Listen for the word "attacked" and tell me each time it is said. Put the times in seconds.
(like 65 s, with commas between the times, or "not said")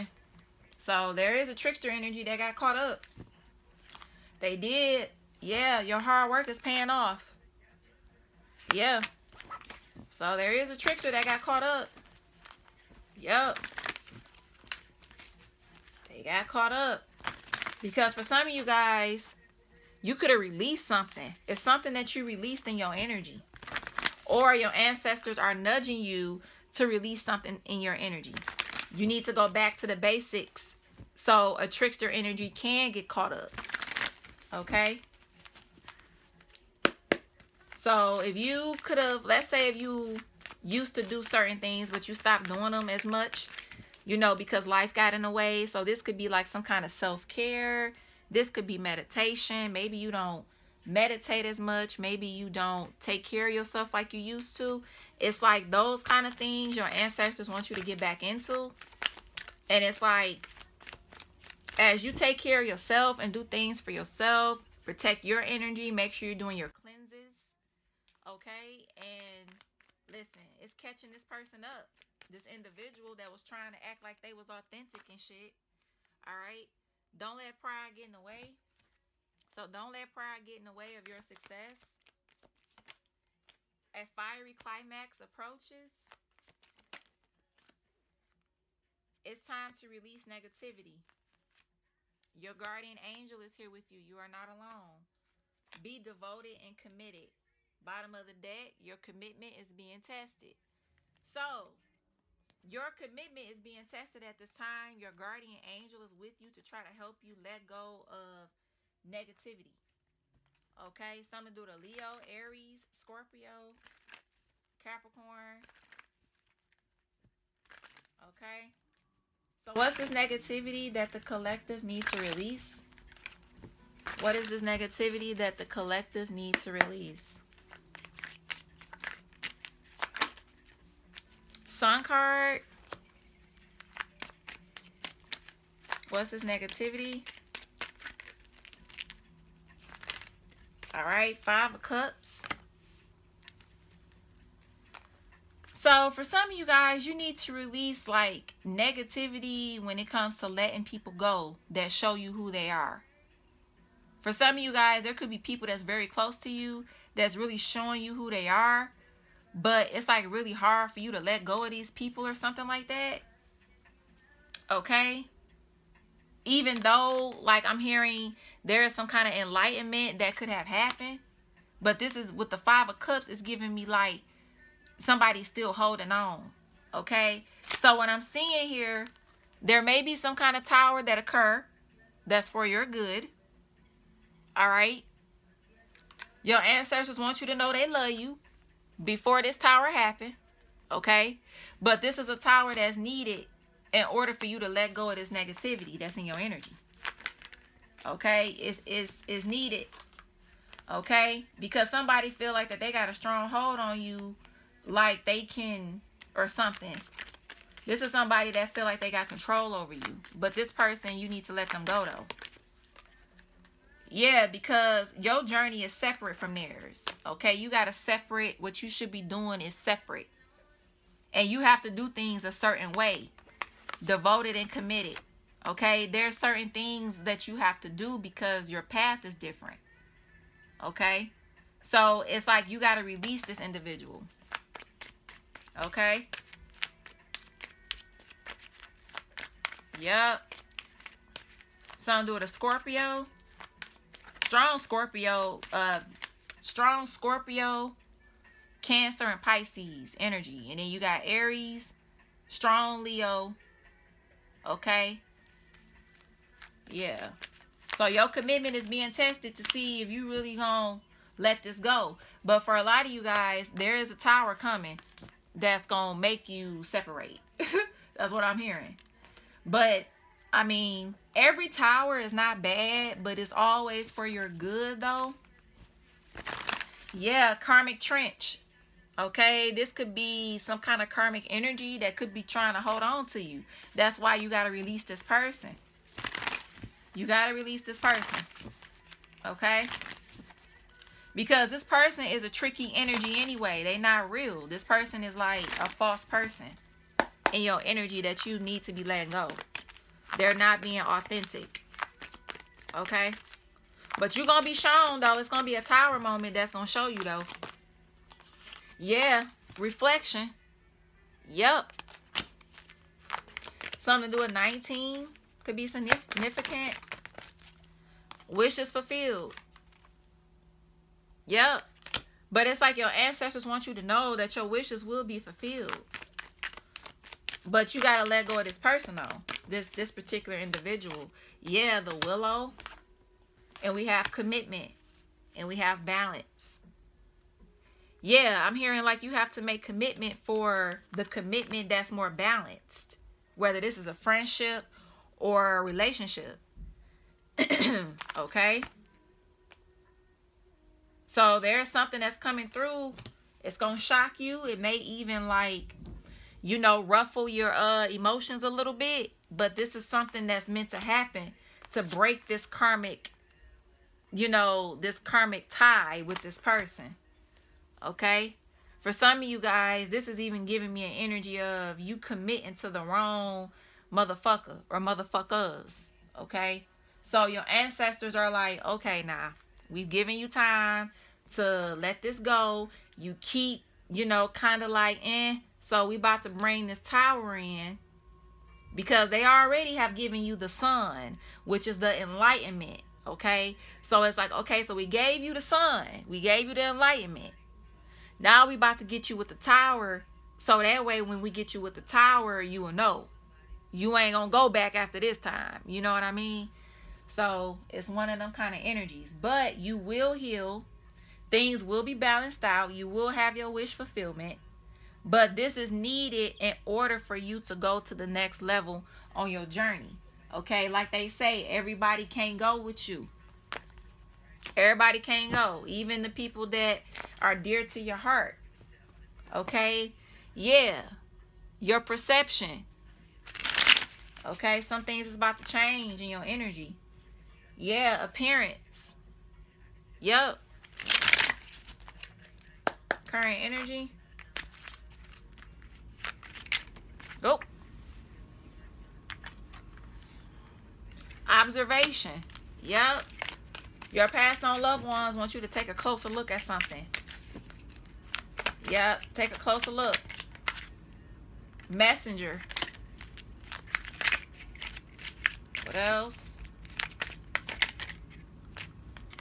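not said.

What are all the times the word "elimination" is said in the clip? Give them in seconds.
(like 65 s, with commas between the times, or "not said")
not said.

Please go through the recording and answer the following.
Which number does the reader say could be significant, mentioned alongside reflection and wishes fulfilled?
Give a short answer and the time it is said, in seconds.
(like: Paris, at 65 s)
19, at 314 s.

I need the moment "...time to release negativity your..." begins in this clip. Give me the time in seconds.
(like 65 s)
89 s.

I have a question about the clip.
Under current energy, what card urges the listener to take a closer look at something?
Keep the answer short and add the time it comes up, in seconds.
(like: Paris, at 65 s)
Observation, at 451 s.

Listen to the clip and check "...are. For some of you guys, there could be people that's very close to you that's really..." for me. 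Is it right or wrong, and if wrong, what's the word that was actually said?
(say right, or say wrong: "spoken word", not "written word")
right.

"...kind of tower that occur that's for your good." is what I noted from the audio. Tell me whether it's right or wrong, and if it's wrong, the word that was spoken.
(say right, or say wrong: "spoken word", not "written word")
right.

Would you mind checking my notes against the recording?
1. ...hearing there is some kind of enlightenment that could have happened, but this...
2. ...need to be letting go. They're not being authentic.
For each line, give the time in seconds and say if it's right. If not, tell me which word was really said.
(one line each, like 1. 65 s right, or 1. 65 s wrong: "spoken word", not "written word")
1. 167 s right
2. 298 s right.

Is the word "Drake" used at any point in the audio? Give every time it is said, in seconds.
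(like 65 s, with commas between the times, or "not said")
not said.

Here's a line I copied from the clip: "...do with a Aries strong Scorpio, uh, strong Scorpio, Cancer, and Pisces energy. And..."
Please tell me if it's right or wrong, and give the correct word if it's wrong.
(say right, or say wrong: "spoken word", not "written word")
wrong: "Scorpio", not "Aries".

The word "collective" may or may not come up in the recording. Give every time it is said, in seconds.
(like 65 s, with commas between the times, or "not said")
121 s, 125 s.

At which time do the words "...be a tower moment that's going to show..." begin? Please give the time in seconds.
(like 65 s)
305 s.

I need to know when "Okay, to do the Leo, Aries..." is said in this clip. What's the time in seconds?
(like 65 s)
110 s.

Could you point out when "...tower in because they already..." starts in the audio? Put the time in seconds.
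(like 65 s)
386 s.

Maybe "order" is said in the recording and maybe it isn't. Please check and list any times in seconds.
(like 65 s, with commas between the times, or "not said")
194 s, 416 s.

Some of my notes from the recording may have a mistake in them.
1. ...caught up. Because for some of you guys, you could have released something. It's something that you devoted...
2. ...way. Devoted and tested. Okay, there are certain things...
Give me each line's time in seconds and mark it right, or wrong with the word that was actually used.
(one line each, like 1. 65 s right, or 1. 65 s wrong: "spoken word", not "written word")
1. 16 s wrong: "released", not "devoted"
2. 222 s wrong: "committed", not "tested".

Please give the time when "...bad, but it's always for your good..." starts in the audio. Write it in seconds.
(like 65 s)
272 s.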